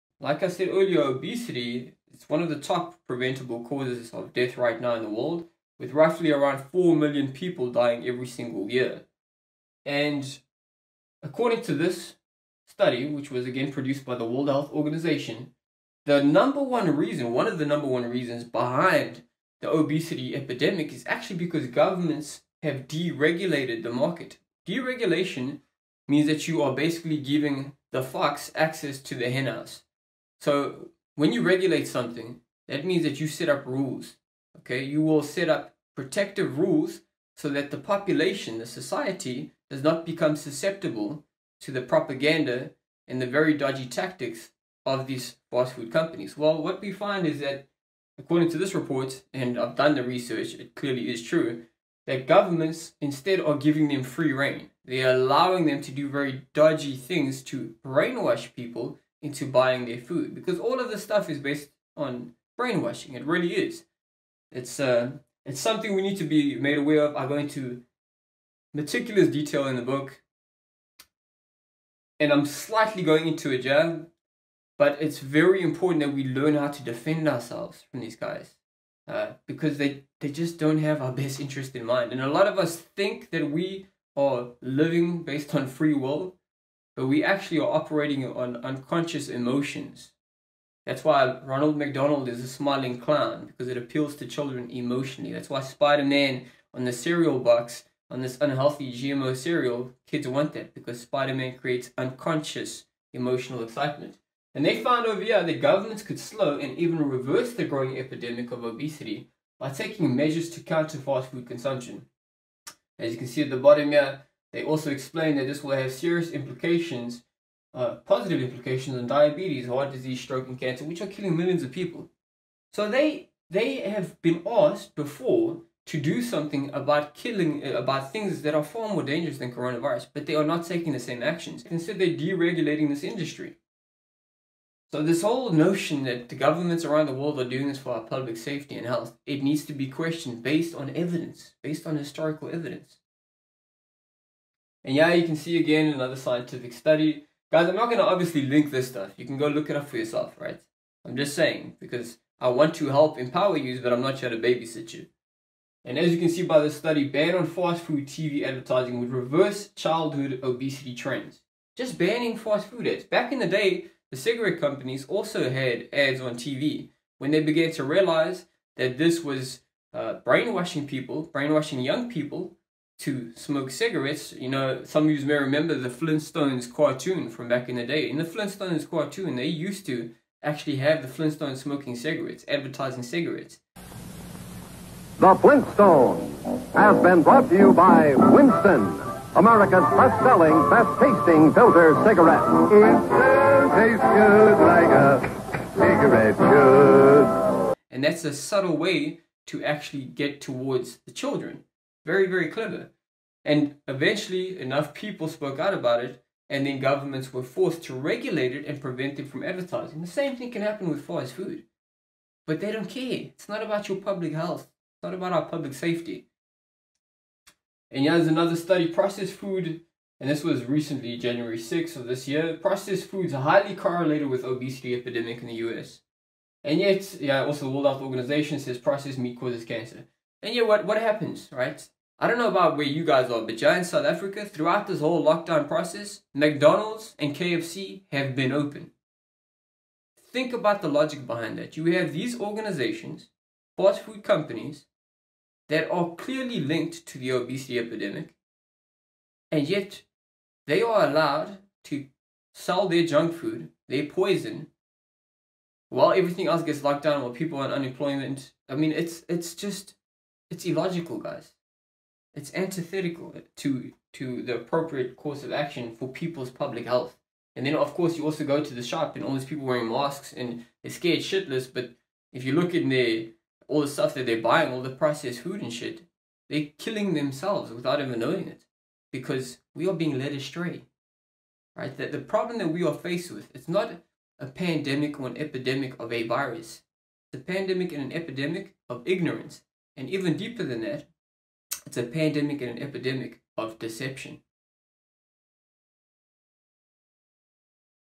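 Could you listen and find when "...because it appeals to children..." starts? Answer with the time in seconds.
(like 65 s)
93 s.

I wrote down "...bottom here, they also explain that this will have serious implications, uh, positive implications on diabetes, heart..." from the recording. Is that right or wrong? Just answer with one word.
right.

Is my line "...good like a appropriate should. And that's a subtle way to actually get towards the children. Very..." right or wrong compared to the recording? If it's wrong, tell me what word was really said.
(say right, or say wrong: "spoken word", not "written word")
wrong: "cigarette", not "appropriate".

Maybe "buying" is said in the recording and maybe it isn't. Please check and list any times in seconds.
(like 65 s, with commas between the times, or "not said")
59 s, 274 s.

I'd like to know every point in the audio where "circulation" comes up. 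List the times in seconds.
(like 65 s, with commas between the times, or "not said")
not said.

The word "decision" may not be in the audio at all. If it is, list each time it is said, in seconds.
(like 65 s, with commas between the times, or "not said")
not said.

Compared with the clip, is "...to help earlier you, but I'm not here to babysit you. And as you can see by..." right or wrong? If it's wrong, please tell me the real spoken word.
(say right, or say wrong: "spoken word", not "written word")
wrong: "empower", not "earlier".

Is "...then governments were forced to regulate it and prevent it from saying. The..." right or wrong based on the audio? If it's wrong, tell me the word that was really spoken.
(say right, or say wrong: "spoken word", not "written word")
wrong: "advertising", not "saying".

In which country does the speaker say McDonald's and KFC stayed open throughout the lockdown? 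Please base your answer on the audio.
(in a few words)
South Africa.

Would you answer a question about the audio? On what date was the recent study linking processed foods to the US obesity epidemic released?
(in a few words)
January 6.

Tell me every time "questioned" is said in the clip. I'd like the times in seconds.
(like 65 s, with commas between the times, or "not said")
139 s.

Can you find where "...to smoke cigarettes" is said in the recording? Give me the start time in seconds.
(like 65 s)
173 s.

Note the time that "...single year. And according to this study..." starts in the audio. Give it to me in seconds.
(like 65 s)
8 s.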